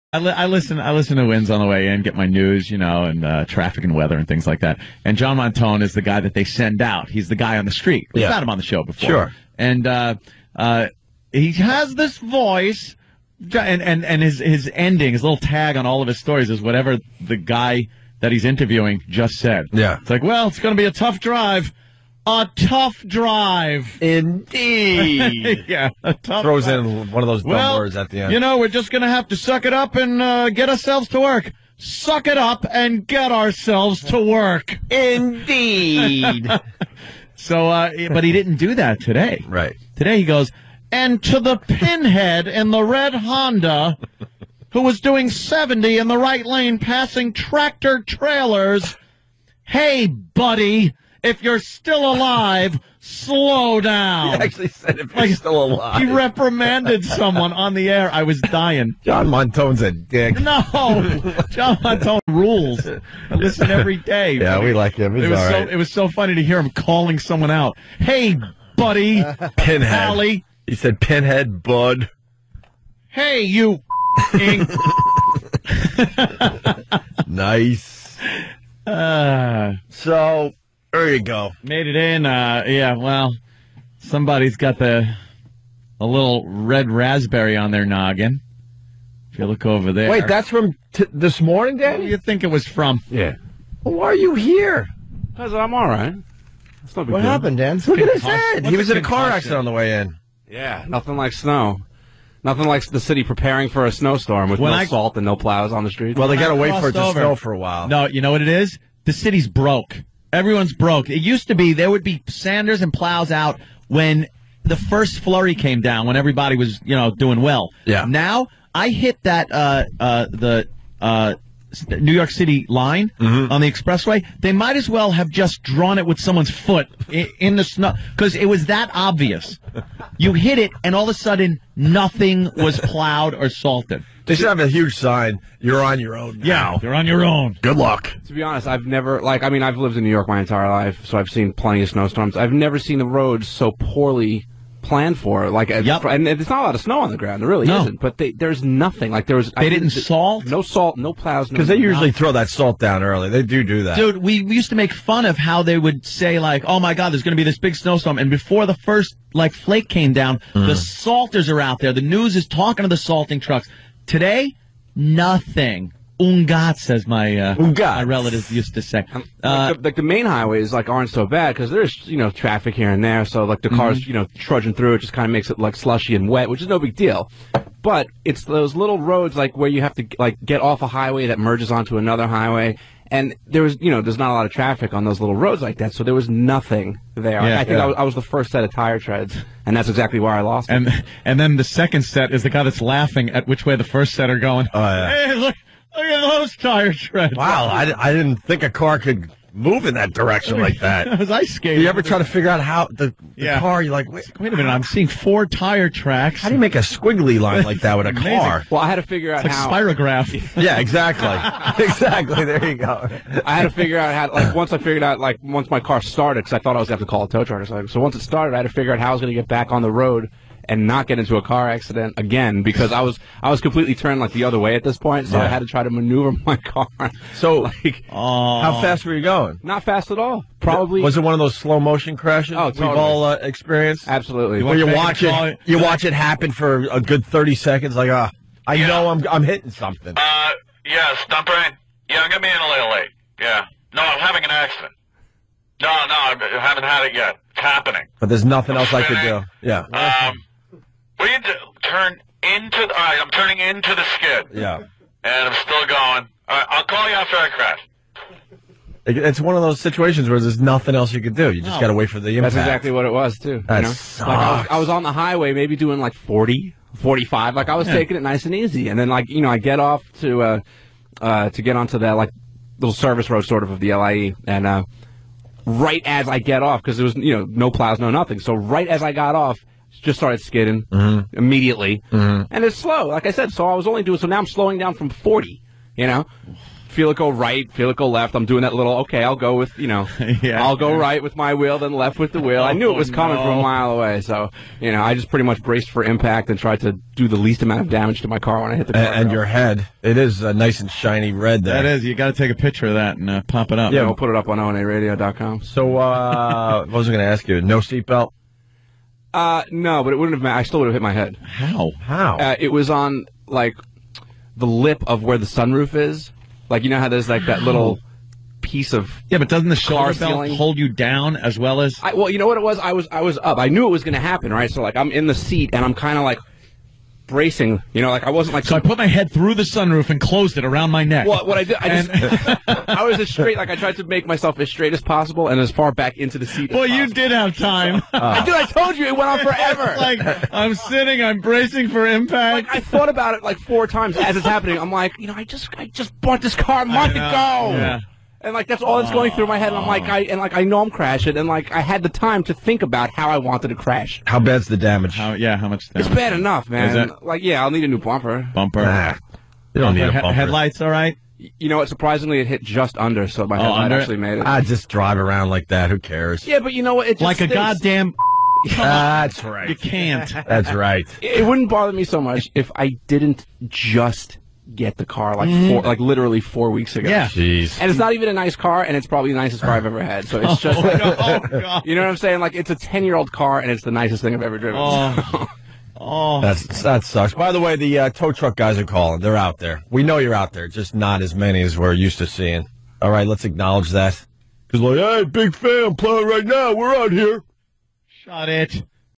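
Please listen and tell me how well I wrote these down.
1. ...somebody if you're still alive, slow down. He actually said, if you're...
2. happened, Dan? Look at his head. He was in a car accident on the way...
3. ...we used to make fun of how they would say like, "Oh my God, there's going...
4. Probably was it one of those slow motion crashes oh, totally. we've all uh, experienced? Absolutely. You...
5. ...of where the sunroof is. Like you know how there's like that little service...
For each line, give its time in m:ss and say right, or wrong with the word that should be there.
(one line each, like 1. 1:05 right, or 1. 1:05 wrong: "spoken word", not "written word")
1. 0:50 wrong: "buddy", not "somebody"
2. 1:37 right
3. 2:34 right
4. 3:50 right
5. 5:15 wrong: "piece", not "service".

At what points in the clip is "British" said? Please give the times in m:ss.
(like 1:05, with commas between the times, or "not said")
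not said.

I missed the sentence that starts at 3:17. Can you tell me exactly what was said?
Wow, I, I didn't think a car could move in that direction like that.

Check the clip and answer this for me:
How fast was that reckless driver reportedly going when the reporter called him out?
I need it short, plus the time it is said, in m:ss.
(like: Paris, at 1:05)
70, at 0:45.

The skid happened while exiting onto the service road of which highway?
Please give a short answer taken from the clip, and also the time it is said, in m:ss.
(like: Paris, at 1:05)
LIE, at 4:33.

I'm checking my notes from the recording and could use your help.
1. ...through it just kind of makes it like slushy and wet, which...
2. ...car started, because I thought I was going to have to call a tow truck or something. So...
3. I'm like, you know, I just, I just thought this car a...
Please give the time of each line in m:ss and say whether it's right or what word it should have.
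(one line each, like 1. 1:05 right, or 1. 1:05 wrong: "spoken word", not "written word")
1. 2:54 right
2. 3:35 right
3. 5:44 wrong: "bought", not "thought".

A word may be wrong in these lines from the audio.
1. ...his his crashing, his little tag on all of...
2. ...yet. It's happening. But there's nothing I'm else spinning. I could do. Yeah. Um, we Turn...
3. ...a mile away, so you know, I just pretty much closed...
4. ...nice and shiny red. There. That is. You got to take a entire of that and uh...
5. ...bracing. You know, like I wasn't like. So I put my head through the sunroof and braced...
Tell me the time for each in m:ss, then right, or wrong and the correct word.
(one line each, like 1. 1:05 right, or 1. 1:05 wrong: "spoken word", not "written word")
1. 0:14 wrong: "ending", not "crashing"
2. 4:07 right
3. 4:53 wrong: "braced", not "closed"
4. 5:00 wrong: "picture", not "entire"
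5. 5:27 wrong: "closed", not "braced".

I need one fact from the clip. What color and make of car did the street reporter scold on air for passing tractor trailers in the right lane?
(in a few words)
Red Honda.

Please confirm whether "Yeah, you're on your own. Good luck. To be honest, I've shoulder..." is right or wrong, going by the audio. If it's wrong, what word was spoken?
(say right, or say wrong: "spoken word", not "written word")
wrong: "never", not "shoulder".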